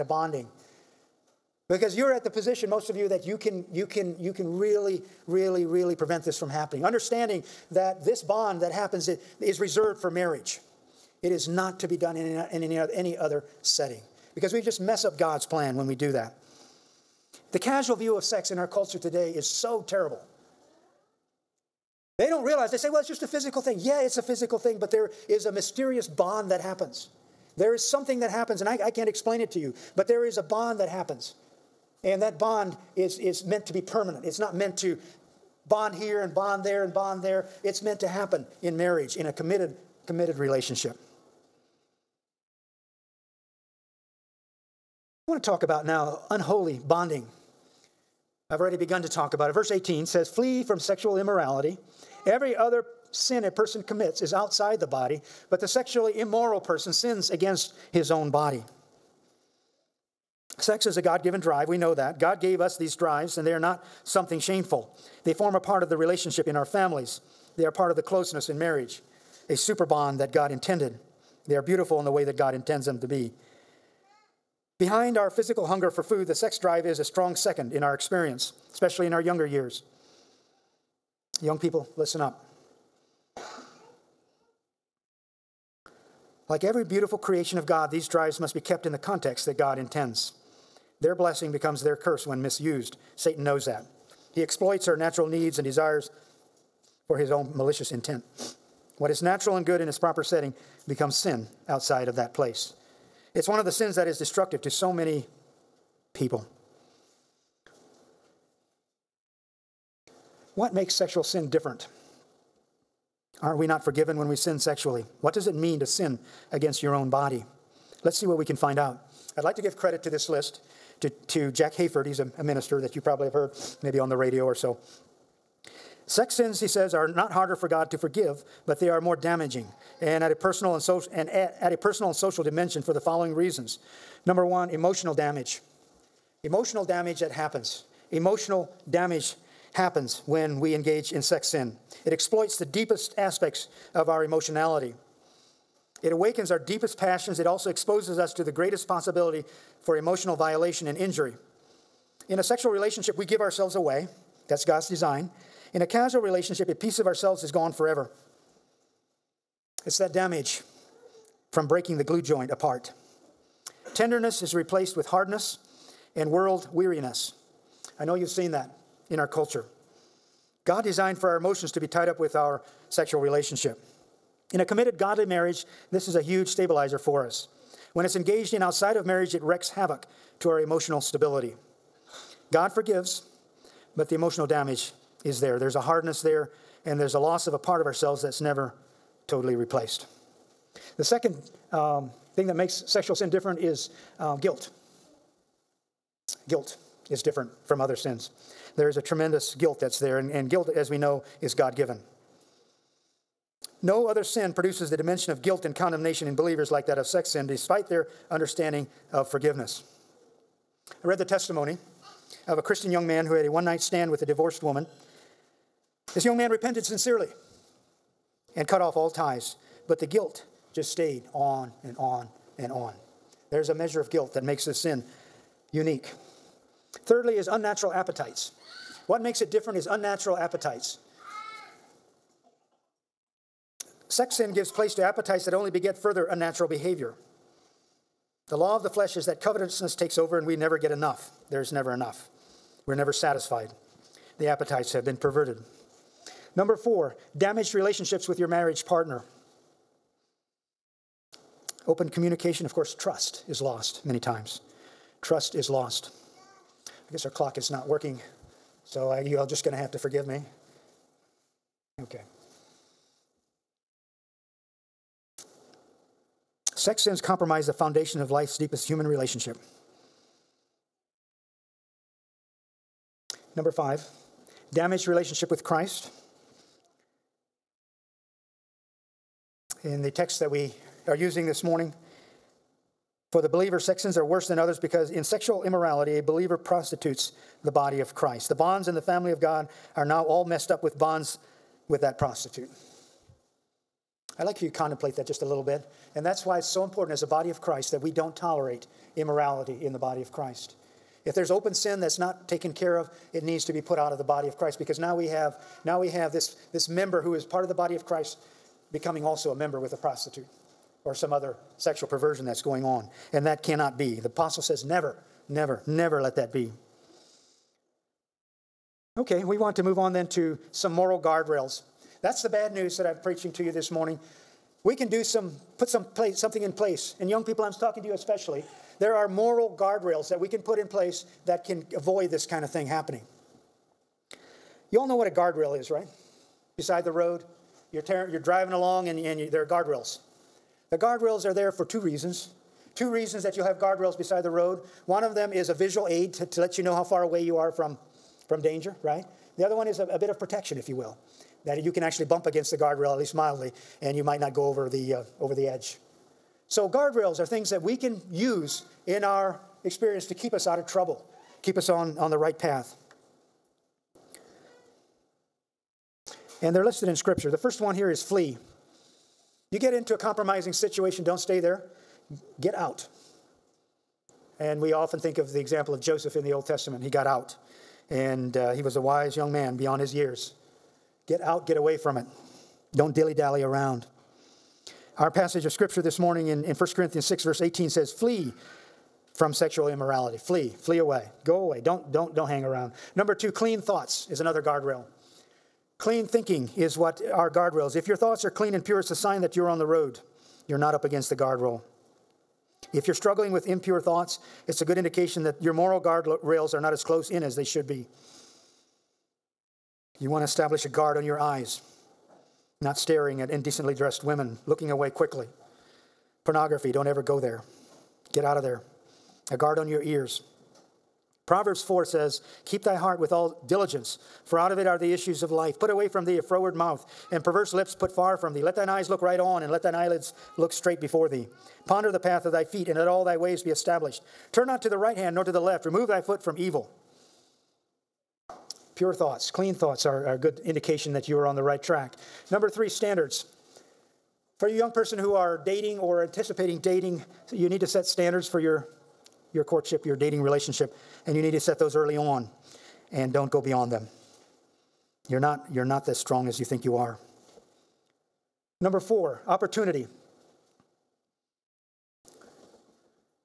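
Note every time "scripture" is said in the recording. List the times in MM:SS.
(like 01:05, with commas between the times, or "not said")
06:07, 06:25.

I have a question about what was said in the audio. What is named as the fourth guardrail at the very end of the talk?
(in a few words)
opportunity.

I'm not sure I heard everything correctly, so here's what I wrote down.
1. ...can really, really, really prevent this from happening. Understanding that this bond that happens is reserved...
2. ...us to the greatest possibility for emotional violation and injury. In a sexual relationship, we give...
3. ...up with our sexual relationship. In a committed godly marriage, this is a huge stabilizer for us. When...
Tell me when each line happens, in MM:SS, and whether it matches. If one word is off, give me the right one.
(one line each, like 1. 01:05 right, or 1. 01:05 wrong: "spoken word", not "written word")
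1. 00:04 right
2. 02:28 right
3. 02:52 right.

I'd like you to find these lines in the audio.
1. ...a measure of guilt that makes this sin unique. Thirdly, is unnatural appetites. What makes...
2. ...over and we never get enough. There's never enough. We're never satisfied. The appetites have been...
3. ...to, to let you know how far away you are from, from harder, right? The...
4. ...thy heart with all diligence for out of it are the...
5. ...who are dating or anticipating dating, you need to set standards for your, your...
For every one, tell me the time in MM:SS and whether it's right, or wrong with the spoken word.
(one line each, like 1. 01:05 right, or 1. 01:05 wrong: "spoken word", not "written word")
1. 03:43 right
2. 04:00 right
3. 05:46 wrong: "danger", not "harder"
4. 07:02 right
5. 07:25 right.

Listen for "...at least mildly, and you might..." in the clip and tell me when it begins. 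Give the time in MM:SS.
05:53.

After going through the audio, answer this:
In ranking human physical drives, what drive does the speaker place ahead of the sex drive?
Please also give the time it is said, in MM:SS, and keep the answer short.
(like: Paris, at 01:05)
hunger for food, at 01:15.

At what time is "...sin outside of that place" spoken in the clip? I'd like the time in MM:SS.
01:41.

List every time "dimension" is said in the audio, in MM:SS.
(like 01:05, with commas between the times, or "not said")
02:12, 03:24.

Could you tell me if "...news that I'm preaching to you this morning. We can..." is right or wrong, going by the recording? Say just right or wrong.
right.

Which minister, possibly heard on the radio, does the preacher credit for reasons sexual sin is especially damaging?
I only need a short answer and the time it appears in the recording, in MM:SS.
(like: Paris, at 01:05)
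Jack Hayford, at 02:01.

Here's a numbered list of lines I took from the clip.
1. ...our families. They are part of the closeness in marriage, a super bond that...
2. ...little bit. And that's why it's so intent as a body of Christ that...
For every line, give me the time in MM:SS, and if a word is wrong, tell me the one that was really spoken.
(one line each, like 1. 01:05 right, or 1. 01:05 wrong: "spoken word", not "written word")
1. 01:06 right
2. 04:55 wrong: "important", not "intent".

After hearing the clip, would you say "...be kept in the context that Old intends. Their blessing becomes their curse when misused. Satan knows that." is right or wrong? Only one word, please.
wrong.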